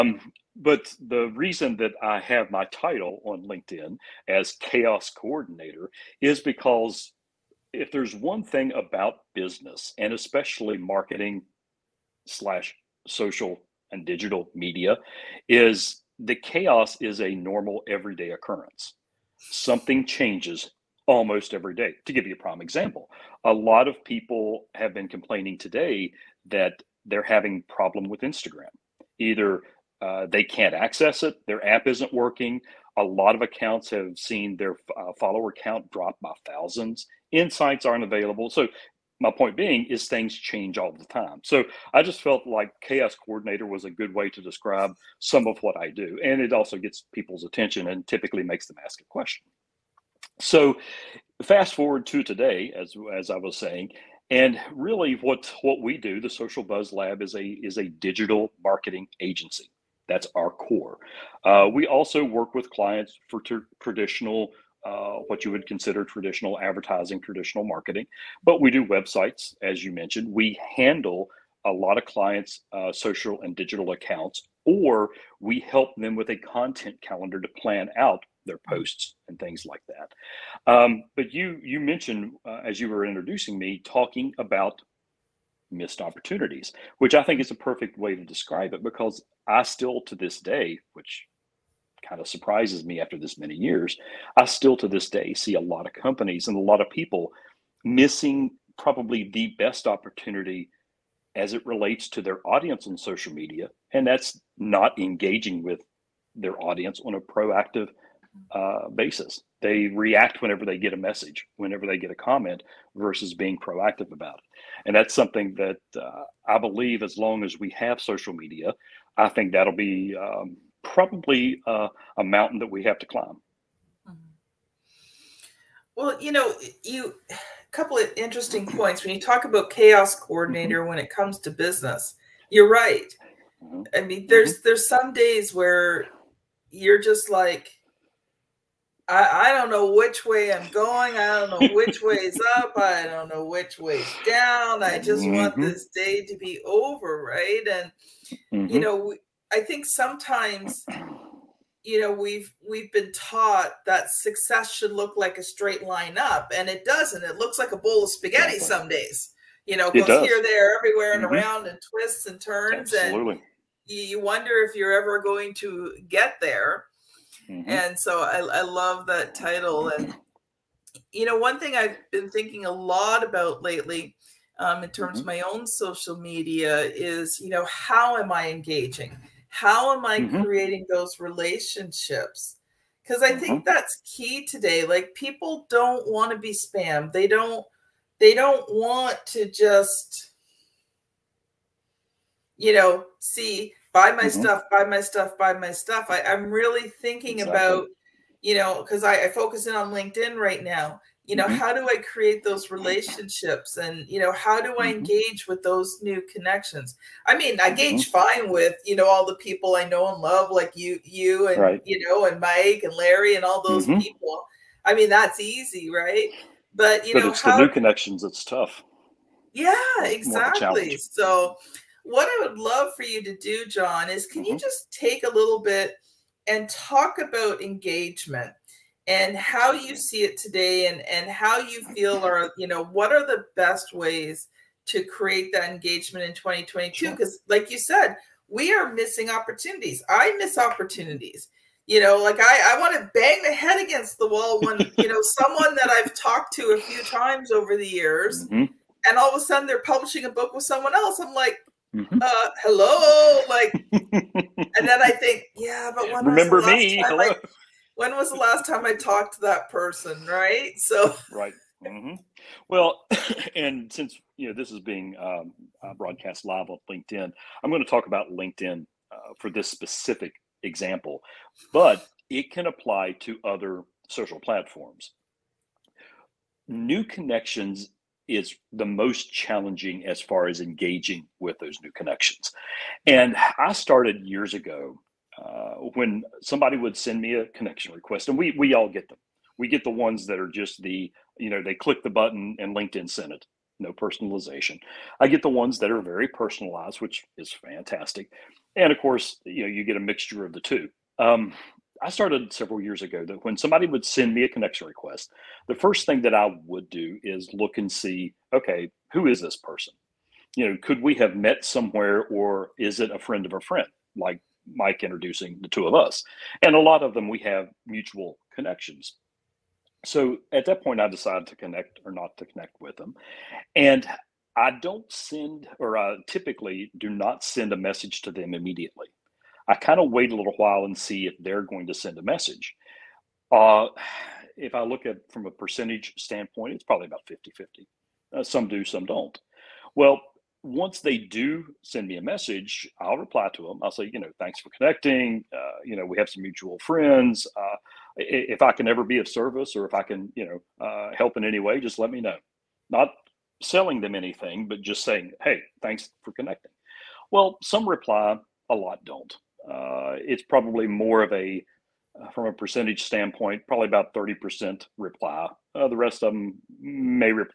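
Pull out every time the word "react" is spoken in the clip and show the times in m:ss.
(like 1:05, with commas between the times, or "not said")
1:49.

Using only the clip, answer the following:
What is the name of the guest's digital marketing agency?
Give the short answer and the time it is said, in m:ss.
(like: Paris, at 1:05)
The Social Buzz Lab, at 0:56.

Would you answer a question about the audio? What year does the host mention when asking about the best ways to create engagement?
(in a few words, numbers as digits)
2022.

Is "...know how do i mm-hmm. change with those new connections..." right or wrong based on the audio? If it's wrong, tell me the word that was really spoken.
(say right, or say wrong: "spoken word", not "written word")
wrong: "engage", not "change".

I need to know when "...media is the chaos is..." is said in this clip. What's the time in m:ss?
0:14.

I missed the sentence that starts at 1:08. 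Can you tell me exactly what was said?
But we do websites, as you mentioned.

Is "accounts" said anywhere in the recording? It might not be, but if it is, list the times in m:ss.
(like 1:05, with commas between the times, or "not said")
0:33, 1:13.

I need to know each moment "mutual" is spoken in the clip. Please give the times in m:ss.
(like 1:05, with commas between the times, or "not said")
5:17, 5:46.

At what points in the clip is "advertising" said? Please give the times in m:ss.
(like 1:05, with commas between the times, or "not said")
1:06.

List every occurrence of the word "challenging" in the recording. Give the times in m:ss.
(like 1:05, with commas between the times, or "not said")
4:39.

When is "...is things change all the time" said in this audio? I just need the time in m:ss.
0:39.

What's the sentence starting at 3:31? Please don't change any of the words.
you know and mike and larry and all those mm-hmm.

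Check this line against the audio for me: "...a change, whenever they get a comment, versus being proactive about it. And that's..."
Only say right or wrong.
wrong.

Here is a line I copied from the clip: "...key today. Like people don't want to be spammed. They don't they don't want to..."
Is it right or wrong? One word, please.
right.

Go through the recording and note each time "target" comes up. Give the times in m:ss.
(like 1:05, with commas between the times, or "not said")
not said.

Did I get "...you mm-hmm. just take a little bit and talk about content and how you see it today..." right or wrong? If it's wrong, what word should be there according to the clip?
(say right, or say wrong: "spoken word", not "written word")
wrong: "engagement", not "content".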